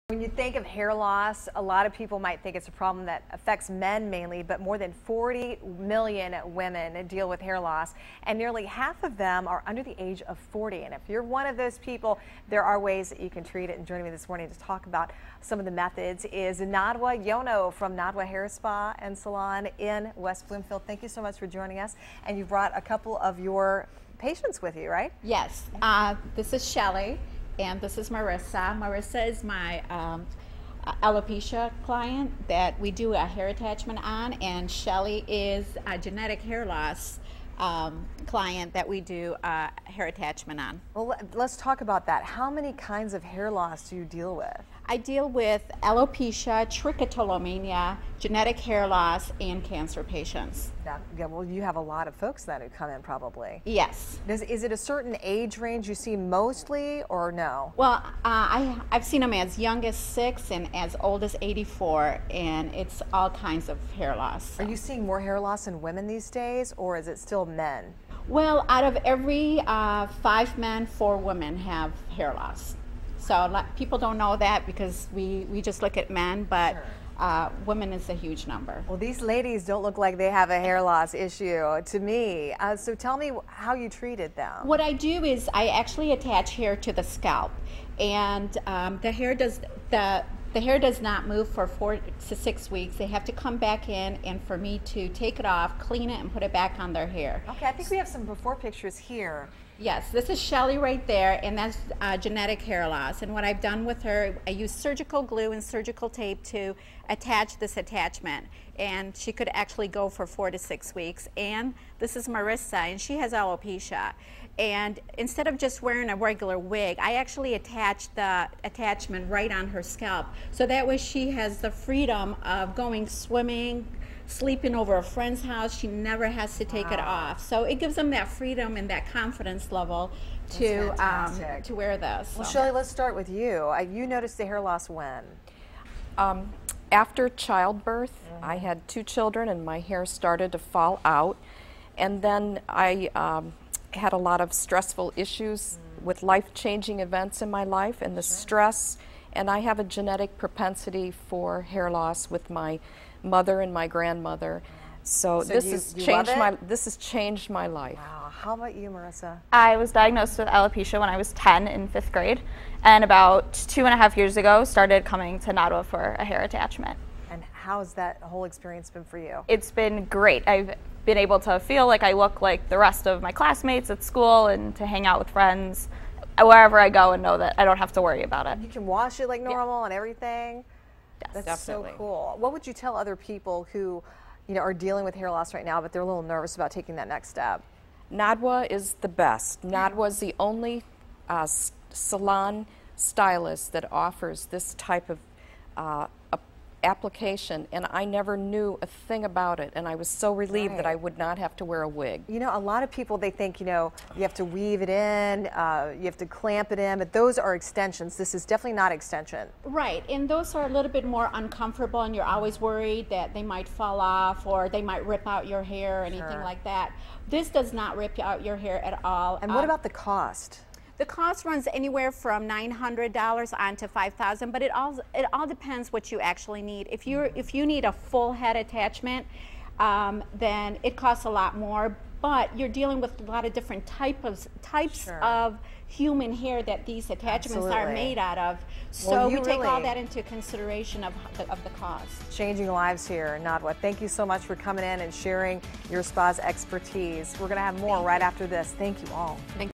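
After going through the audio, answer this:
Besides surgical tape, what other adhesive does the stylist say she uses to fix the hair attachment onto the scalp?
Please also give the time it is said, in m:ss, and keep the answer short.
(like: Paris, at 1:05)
Surgical glue, at 1:44.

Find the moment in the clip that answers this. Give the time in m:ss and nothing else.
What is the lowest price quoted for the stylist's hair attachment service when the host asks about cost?
3:42.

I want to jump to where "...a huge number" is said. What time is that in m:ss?
1:18.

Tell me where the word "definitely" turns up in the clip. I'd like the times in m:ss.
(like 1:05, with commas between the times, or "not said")
3:01, 3:28.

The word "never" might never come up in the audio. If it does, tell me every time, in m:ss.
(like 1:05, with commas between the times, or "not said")
2:05, 3:18.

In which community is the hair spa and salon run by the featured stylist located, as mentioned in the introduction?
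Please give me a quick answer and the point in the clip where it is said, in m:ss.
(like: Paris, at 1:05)
West Bloomfield, at 0:20.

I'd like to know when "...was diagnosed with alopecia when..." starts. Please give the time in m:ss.
2:39.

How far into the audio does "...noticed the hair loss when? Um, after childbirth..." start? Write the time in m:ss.
2:14.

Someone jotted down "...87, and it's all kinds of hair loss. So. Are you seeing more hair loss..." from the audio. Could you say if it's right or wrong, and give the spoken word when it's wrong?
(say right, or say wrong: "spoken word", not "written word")
wrong: "84", not "87".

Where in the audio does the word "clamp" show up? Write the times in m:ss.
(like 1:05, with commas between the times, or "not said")
3:26.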